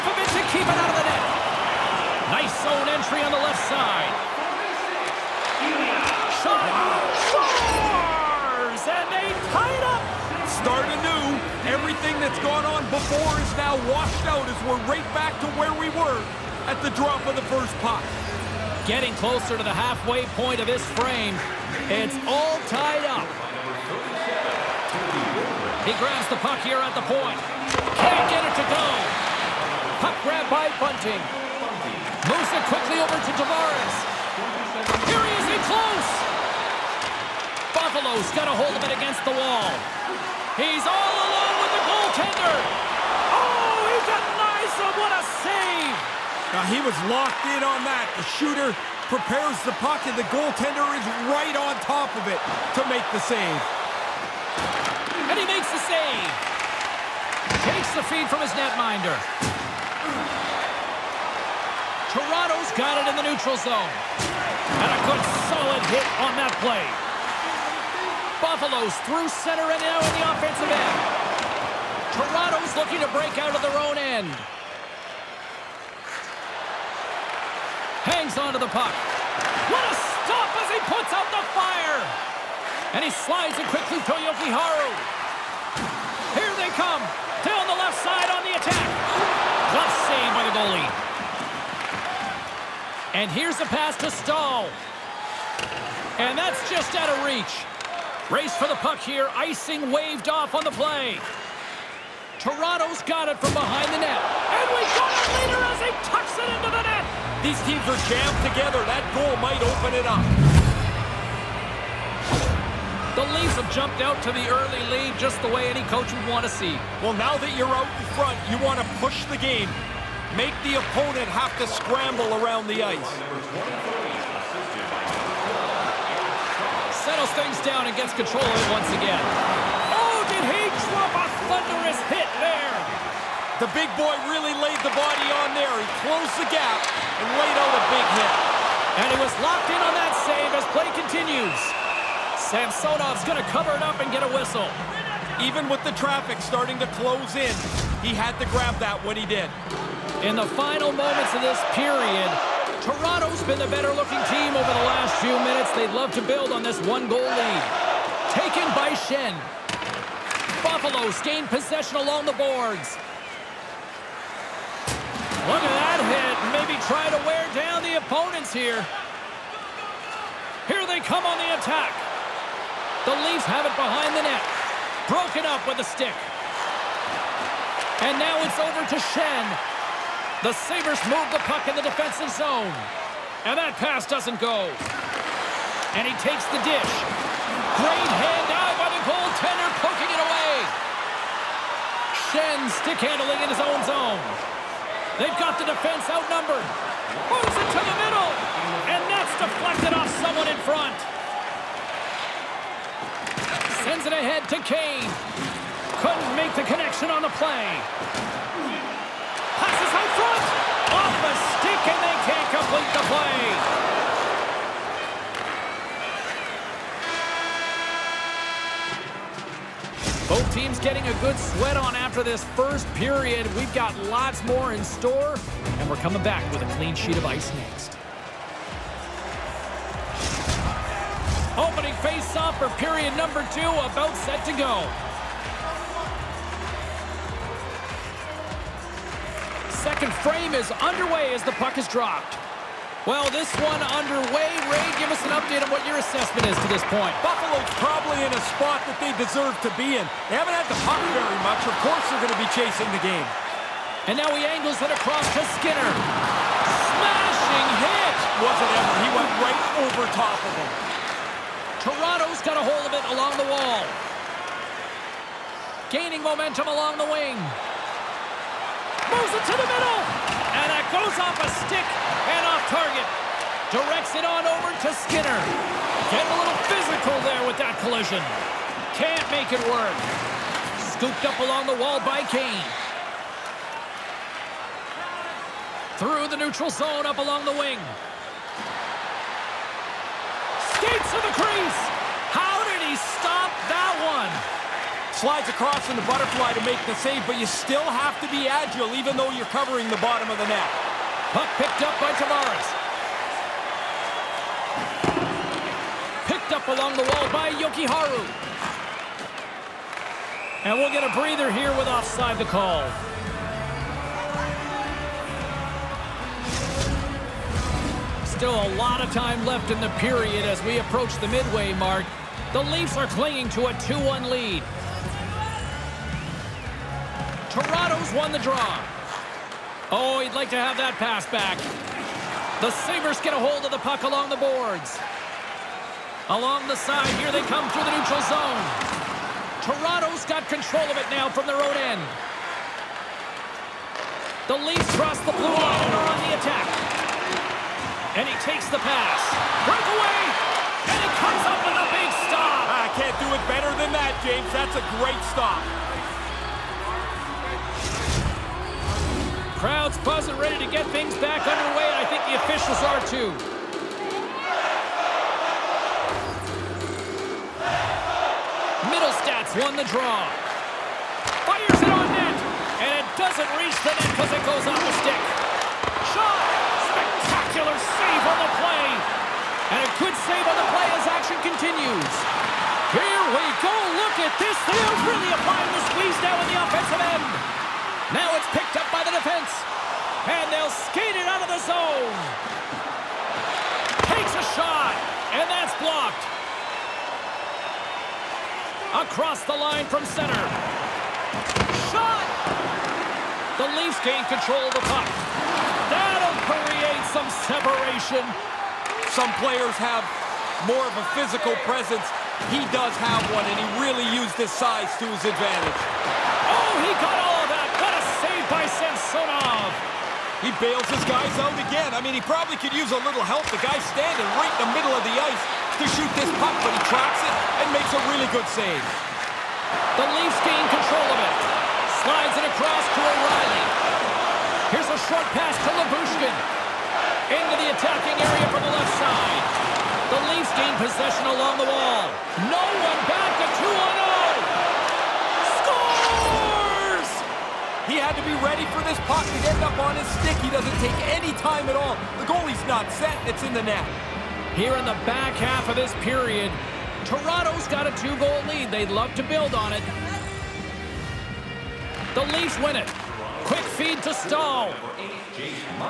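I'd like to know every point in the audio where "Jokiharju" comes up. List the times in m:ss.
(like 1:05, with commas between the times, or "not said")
1:24, 5:07.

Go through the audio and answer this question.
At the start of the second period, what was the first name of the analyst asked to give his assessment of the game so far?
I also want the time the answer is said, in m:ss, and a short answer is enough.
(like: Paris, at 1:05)
Ray, at 4:04.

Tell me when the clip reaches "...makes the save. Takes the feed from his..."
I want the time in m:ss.
0:55.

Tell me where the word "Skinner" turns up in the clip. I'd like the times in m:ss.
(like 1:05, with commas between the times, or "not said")
4:15, 4:35.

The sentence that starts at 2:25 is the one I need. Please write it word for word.
Even with the traffic starting to close in, he had to grab that when he did.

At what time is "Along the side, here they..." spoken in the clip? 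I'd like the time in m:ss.
5:36.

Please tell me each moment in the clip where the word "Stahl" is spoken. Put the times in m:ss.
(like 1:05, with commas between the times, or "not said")
1:34, 7:44.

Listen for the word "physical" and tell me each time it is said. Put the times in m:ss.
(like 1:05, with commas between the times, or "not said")
4:36, 6:51.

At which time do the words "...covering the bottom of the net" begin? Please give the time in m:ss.
4:59.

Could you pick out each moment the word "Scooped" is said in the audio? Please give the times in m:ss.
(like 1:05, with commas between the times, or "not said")
4:40.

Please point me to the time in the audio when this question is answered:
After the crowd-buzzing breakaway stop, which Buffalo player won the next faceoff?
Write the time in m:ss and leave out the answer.
6:08.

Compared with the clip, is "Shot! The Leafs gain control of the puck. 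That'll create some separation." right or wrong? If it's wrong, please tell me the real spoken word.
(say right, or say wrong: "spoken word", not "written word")
right.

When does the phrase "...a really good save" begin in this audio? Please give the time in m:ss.
7:07.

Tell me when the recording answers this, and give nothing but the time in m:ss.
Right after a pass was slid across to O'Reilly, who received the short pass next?
7:15.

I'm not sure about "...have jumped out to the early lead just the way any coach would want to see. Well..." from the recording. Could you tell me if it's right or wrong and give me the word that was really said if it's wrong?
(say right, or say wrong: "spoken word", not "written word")
right.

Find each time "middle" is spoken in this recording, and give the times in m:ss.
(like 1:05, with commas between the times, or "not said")
3:17, 4:29, 7:04.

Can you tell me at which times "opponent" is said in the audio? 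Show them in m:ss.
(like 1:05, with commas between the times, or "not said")
2:00, 2:47.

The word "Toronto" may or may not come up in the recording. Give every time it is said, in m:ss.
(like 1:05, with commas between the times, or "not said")
1:02, 1:12, 1:42, 2:32, 4:21, 5:27, 5:39, 7:37.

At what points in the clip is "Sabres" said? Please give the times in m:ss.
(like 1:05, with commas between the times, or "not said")
3:00, 5:32.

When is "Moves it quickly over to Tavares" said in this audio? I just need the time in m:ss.
0:32.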